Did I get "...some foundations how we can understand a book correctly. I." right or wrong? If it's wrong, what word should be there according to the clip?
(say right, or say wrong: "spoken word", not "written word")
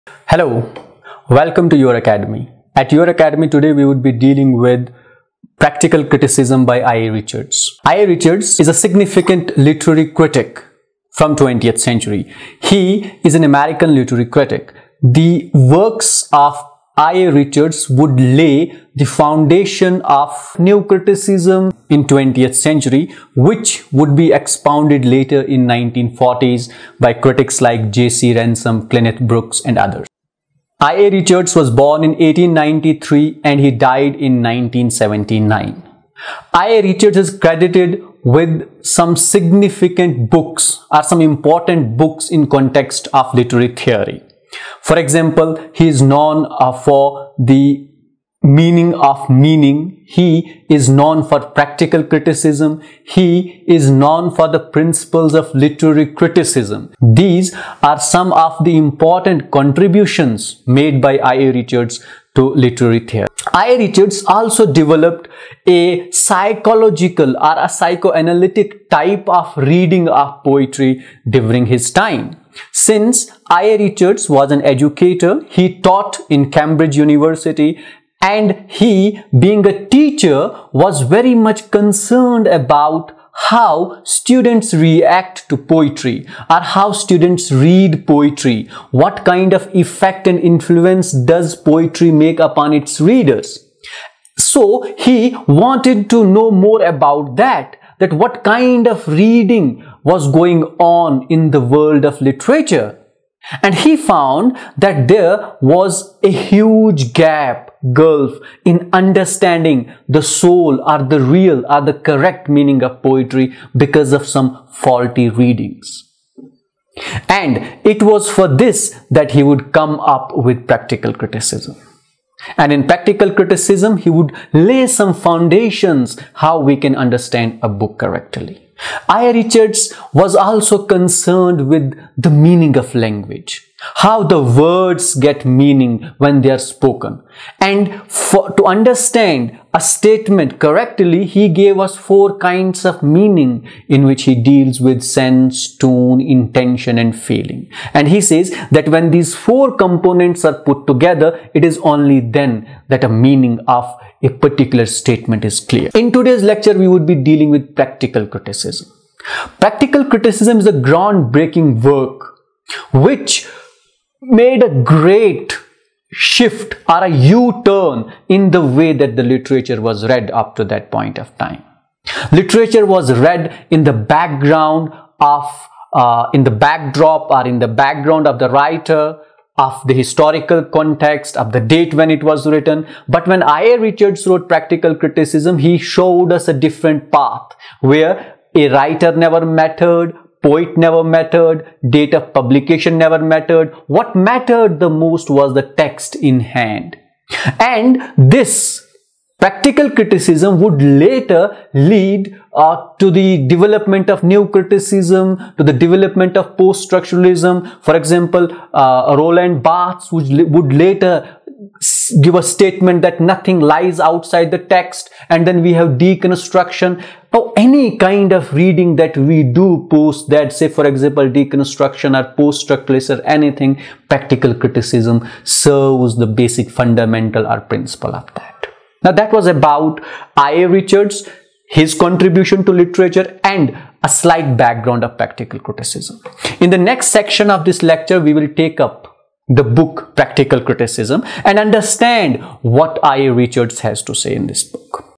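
right.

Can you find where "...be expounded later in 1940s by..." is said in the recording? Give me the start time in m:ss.
0:24.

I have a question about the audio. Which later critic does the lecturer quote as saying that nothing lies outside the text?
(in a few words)
Roland Barthes.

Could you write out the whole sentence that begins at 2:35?
In today's lecture, we would be dealing with practical criticism.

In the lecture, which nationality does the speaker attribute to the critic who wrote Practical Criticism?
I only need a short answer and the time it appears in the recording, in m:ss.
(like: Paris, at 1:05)
American, at 0:13.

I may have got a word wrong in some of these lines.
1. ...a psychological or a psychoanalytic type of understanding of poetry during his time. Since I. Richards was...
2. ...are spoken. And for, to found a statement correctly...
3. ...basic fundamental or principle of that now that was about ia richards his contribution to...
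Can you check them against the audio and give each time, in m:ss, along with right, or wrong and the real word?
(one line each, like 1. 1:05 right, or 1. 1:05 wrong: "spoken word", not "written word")
1. 1:05 wrong: "reading", not "understanding"
2. 2:16 wrong: "understand", not "found"
3. 3:46 right.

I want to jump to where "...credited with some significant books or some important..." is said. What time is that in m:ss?
0:37.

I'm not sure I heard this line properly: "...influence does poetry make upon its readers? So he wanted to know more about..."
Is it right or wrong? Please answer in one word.
right.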